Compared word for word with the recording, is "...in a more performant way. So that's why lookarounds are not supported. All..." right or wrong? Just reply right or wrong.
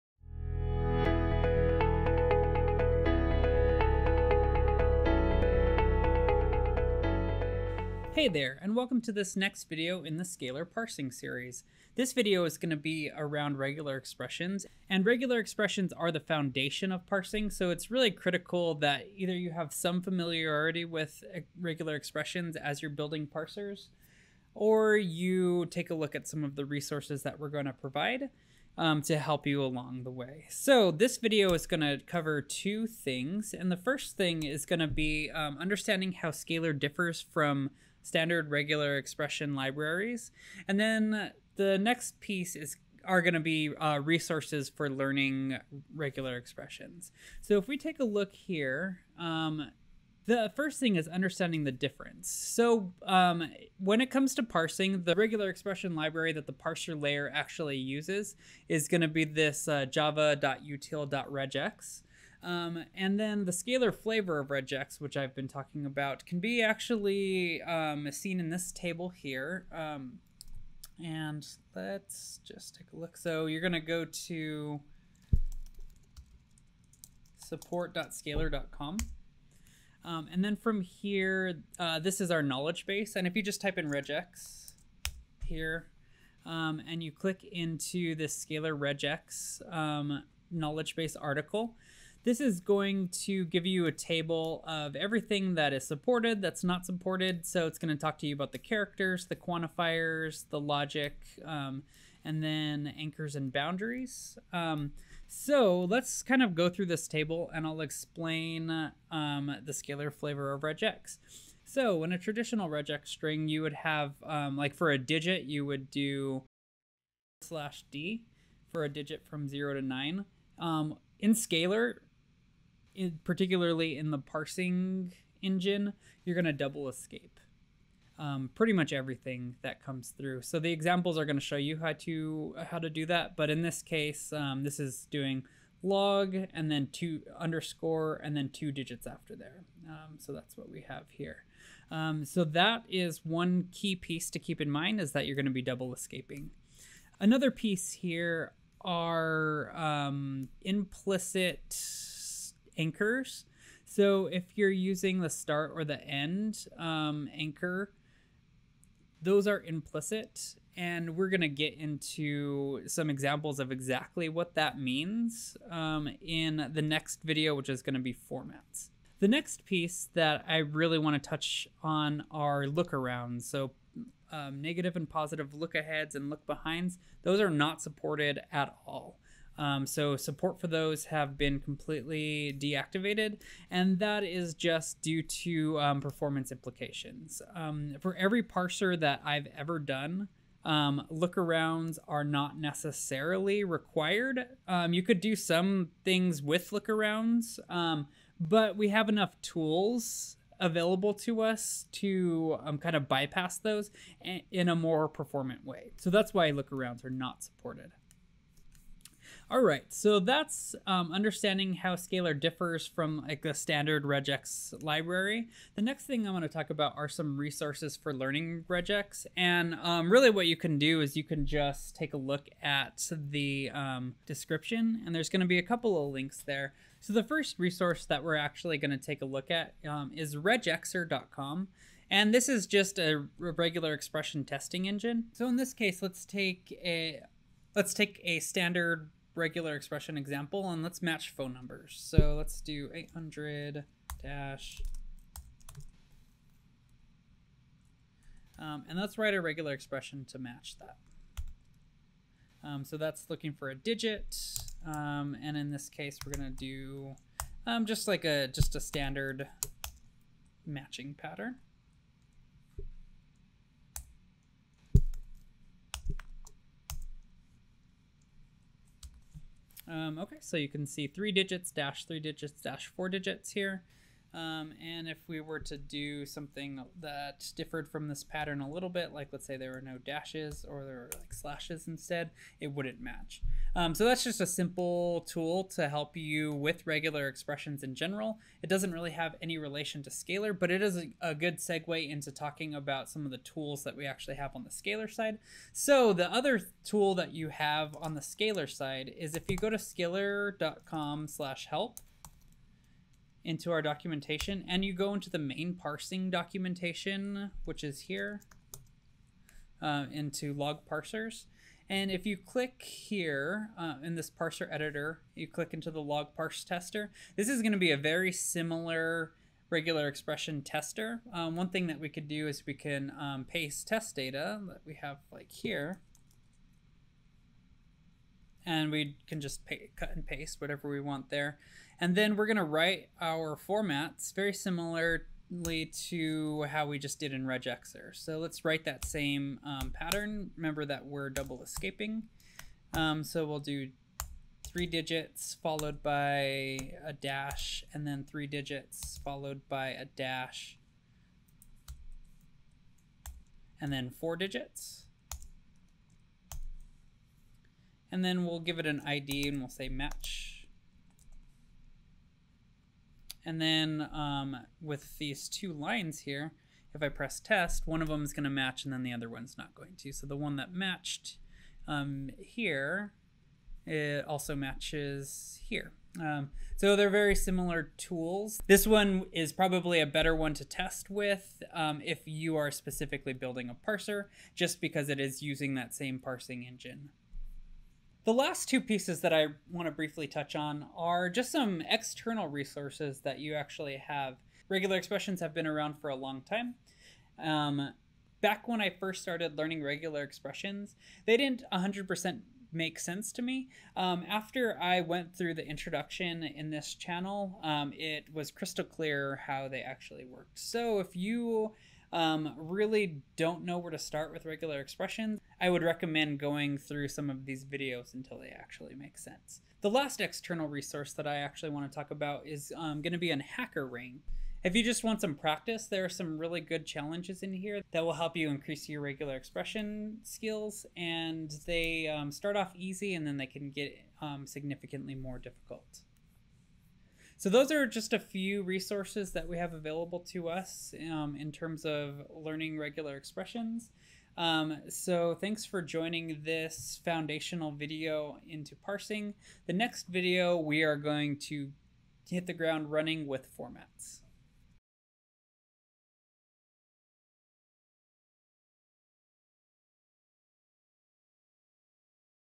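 right.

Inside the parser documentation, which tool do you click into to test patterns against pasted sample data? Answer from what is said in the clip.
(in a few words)
Log parse tester.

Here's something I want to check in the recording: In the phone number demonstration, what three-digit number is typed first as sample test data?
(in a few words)
800.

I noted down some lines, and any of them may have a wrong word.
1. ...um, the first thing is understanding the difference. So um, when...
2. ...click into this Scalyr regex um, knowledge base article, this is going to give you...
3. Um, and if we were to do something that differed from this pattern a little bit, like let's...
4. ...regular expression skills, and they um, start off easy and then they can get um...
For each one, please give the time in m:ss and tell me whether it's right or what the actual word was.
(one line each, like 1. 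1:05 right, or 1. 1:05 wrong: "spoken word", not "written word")
1. 0:49 right
2. 1:27 right
3. 4:34 right
4. 7:09 right.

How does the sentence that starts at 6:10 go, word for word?
So the one that matched um, here, it also matches here.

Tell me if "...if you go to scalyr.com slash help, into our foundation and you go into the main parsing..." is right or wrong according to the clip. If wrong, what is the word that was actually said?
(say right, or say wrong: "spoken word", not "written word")
wrong: "documentation", not "foundation".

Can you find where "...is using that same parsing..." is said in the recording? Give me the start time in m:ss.
6:25.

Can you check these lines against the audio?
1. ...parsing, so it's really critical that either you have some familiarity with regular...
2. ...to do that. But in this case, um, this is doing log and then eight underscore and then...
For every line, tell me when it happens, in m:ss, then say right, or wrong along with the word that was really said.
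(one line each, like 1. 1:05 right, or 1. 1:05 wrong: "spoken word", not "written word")
1. 0:17 right
2. 2:12 wrong: "two", not "eight".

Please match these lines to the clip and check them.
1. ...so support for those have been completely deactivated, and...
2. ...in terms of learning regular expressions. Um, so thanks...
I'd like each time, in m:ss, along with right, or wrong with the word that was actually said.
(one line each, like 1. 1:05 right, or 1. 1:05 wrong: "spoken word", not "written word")
1. 2:59 right
2. 7:21 right.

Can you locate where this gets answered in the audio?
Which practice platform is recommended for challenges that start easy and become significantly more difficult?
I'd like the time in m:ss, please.
7:03.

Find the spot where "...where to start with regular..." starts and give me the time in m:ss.
6:53.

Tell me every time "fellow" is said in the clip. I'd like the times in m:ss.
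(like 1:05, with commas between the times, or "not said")
not said.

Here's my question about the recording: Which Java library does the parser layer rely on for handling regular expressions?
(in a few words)
java.util.regex.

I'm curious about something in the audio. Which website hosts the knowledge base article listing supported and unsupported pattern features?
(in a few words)
support.scalyr.com.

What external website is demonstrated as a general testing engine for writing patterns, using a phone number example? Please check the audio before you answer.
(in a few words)
regexr.com.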